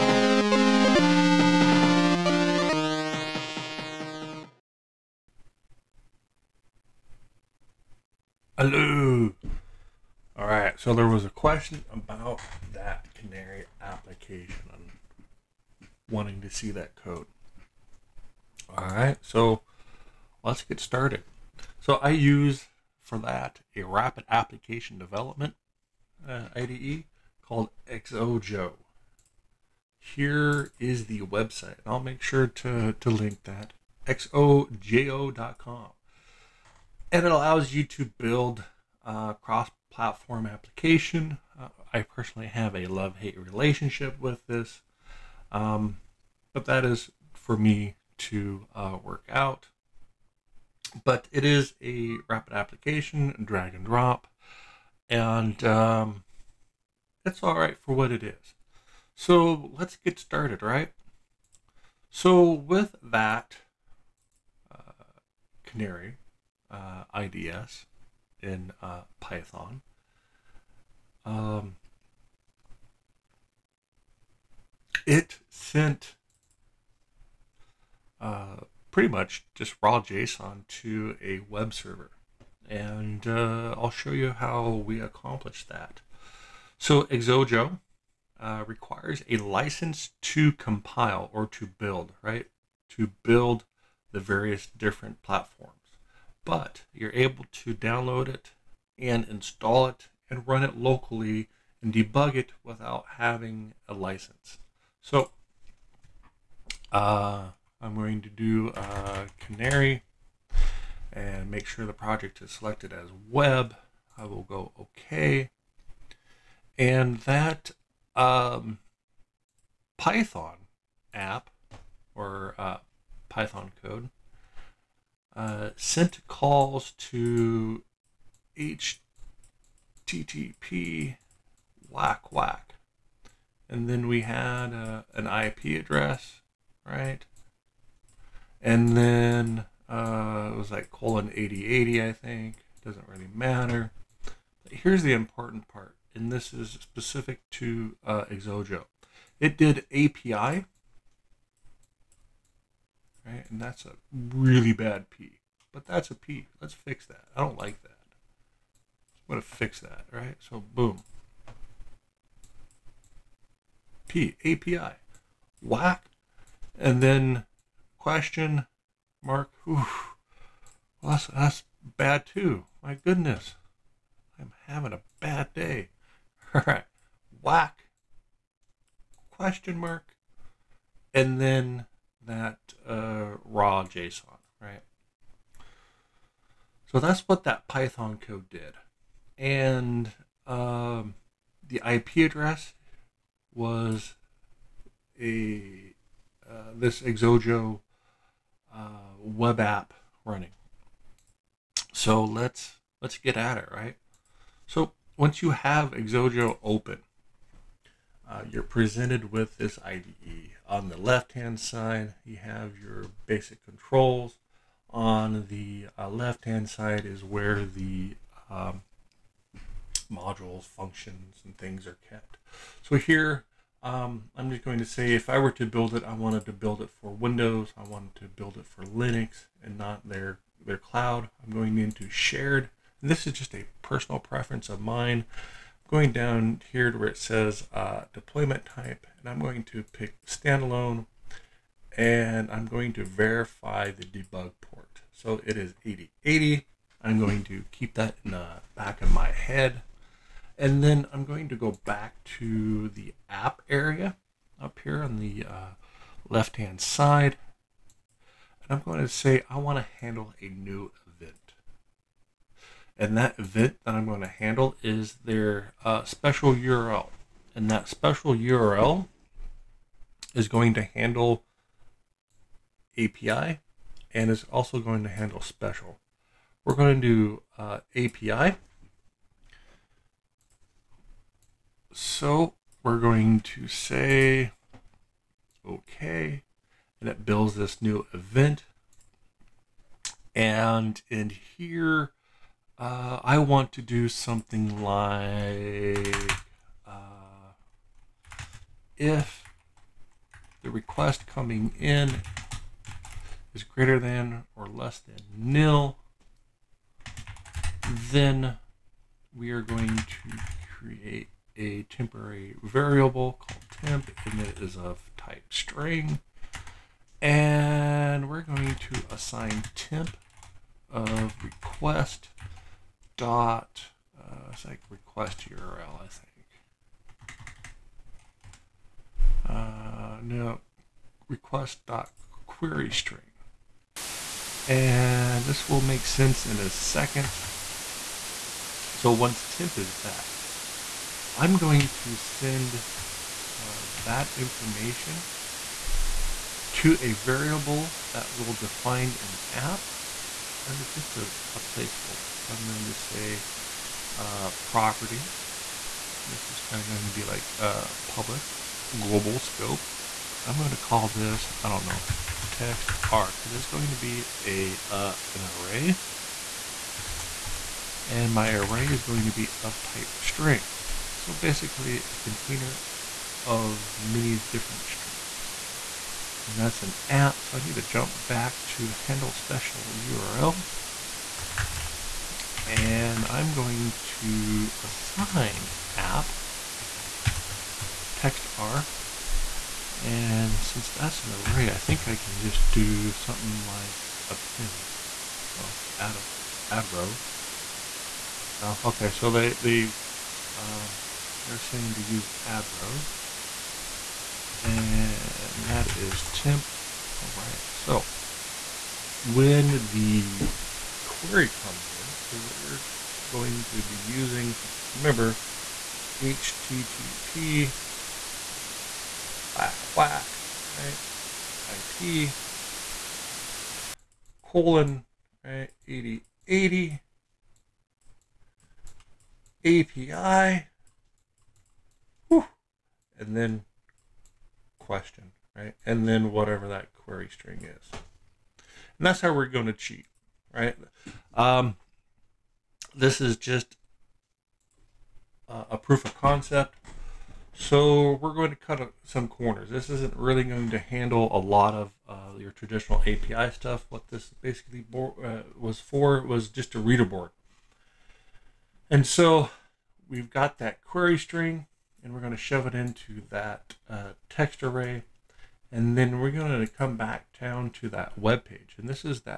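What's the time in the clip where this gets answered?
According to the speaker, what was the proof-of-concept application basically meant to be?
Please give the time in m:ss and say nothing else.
7:36.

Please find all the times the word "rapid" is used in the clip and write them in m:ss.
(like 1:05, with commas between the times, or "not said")
0:23, 0:52.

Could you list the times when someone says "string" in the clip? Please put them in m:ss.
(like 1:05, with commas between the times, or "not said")
5:15, 5:32, 6:10, 6:14, 7:17, 7:41.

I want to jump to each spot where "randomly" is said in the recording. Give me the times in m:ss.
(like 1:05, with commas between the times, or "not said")
not said.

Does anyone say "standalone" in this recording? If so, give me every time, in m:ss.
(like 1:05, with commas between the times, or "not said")
4:00.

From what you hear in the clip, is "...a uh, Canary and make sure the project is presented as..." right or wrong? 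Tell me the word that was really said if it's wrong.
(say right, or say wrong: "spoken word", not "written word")
wrong: "selected", not "presented".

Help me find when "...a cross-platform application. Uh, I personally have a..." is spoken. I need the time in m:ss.
0:39.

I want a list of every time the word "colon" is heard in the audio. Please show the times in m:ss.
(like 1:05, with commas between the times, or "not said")
2:20, 7:04.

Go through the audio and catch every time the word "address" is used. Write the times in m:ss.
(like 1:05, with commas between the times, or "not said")
2:15, 3:12.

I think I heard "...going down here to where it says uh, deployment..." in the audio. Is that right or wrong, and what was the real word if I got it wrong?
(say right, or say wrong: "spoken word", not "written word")
right.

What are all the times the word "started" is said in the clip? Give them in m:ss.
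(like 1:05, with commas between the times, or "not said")
0:20, 1:00.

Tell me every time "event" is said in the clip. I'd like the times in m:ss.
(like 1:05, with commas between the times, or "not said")
4:23, 4:48.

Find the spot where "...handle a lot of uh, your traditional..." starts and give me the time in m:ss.
7:30.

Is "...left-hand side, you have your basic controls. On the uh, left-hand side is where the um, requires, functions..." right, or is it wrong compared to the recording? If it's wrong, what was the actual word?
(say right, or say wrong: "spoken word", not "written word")
wrong: "modules", not "requires".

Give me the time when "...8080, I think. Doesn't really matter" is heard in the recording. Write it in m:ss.
2:21.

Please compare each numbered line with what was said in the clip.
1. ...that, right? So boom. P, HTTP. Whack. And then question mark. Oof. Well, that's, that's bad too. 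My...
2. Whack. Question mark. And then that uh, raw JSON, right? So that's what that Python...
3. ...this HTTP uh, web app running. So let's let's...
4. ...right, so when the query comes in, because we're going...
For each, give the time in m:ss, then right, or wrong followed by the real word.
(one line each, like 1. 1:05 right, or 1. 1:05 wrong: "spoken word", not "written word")
1. 2:39 wrong: "API", not "HTTP"
2. 2:57 right
3. 3:16 wrong: "Xojo", not "HTTP"
4. 6:47 right.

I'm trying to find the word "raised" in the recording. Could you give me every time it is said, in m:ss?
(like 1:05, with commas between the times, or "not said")
not said.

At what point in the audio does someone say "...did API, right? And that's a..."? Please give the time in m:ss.
2:29.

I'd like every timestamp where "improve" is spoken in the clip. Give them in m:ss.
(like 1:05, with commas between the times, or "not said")
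not said.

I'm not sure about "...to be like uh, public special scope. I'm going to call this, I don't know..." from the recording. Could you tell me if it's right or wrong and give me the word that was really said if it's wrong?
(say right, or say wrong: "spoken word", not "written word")
wrong: "global", not "special".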